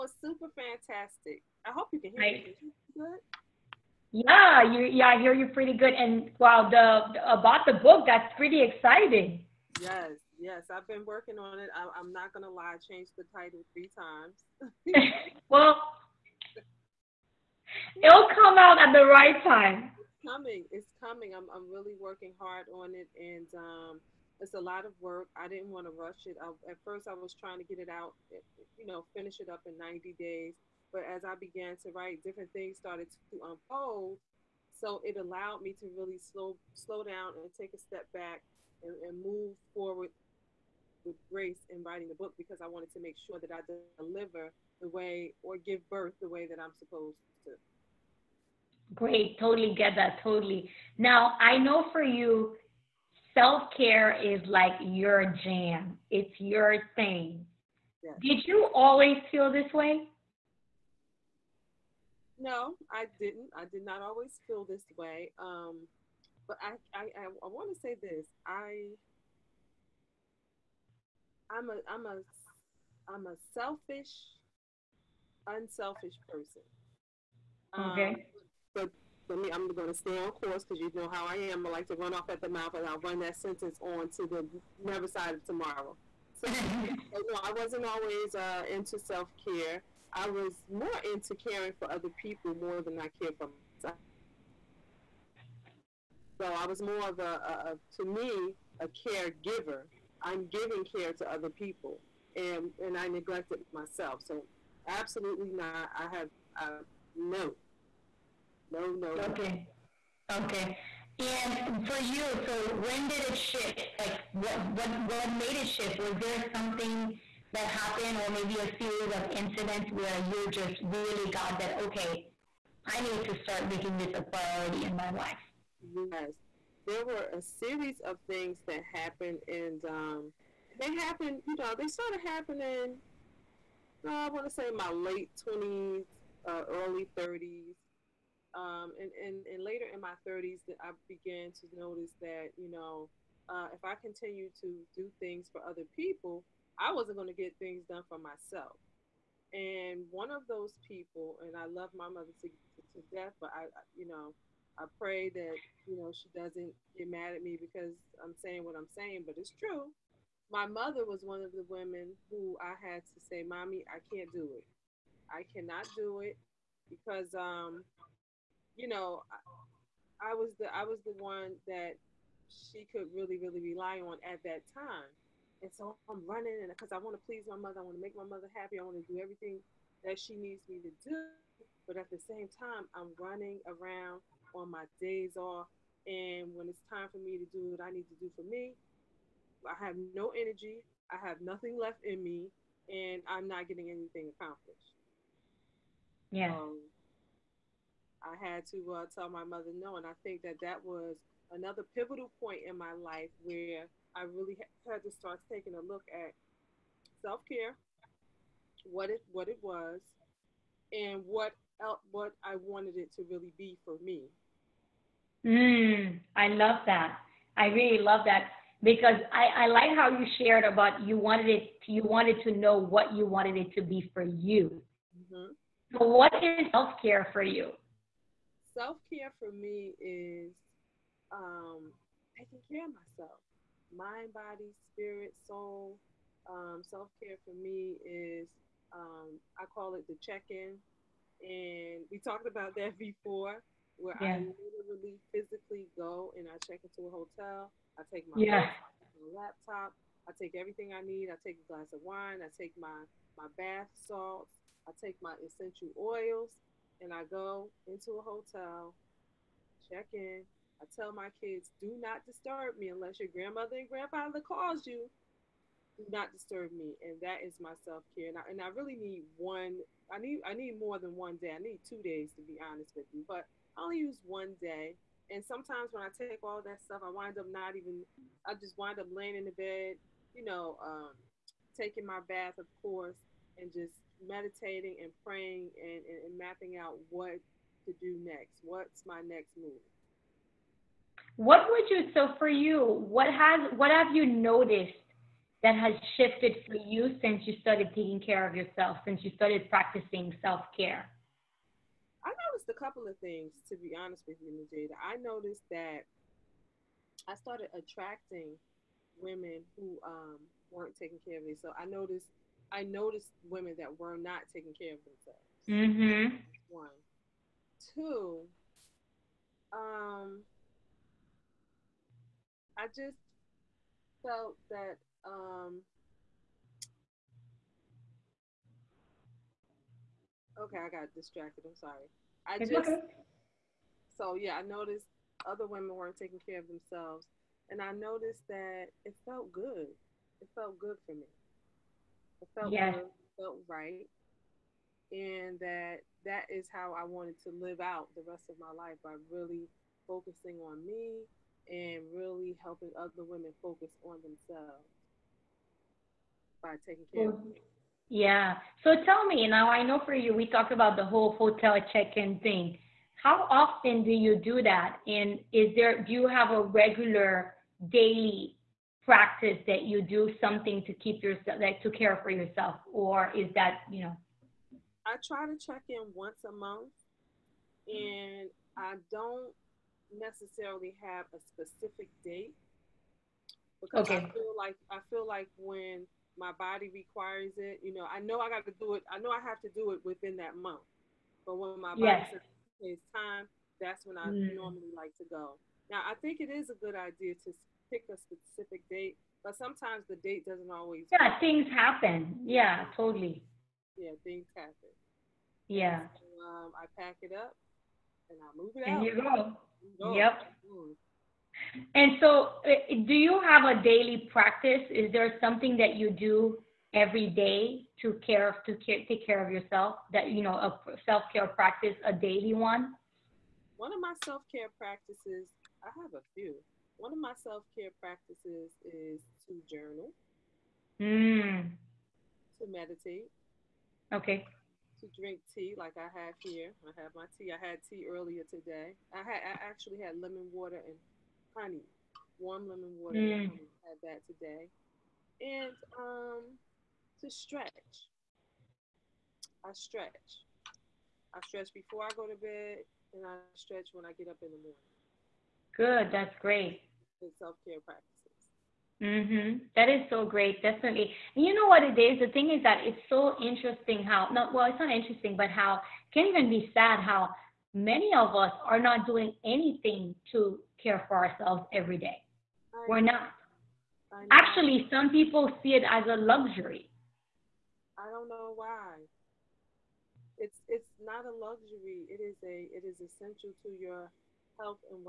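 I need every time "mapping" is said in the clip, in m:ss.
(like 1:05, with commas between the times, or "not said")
4:46.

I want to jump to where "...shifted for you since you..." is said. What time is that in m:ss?
4:56.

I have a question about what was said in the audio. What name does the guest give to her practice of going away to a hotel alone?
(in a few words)
The check in.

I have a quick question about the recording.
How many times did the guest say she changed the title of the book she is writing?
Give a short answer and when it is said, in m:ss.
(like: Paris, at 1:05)
3, at 0:13.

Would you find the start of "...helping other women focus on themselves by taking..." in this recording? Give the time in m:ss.
5:52.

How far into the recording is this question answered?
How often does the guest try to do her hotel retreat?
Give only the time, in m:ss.
6:16.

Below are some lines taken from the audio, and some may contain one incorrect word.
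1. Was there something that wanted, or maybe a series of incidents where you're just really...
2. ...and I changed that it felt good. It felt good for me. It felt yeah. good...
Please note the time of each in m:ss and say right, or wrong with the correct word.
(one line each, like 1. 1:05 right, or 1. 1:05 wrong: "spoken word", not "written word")
1. 1:56 wrong: "happened", not "wanted"
2. 5:37 wrong: "noticed", not "changed".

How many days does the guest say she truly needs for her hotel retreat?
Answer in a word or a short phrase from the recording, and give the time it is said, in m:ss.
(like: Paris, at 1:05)
2, at 4:31.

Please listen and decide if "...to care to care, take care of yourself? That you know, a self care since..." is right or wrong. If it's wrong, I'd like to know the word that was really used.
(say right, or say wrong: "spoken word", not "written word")
wrong: "practice", not "since".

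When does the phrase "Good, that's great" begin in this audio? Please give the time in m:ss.
7:35.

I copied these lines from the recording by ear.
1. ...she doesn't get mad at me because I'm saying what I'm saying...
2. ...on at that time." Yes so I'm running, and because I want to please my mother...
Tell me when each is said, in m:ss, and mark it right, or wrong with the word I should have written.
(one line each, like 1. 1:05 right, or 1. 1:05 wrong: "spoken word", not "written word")
1. 2:36 right
2. 2:54 wrong: "And", not "Yes".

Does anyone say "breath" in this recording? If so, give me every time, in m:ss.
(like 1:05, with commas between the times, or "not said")
not said.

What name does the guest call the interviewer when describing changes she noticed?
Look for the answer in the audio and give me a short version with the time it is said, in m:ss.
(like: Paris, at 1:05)
Nadjejda, at 5:04.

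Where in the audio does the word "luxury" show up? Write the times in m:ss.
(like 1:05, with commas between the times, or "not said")
7:56, 8:01.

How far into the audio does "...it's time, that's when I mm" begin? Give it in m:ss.
6:32.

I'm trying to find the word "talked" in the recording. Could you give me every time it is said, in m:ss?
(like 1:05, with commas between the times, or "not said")
4:02, 6:00.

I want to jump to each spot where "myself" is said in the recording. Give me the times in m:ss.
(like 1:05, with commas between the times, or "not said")
1:33, 1:43, 2:28, 3:52.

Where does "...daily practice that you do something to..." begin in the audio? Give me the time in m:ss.
6:07.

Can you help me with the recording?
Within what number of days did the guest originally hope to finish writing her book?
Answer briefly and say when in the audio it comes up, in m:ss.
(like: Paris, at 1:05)
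90 days, at 0:29.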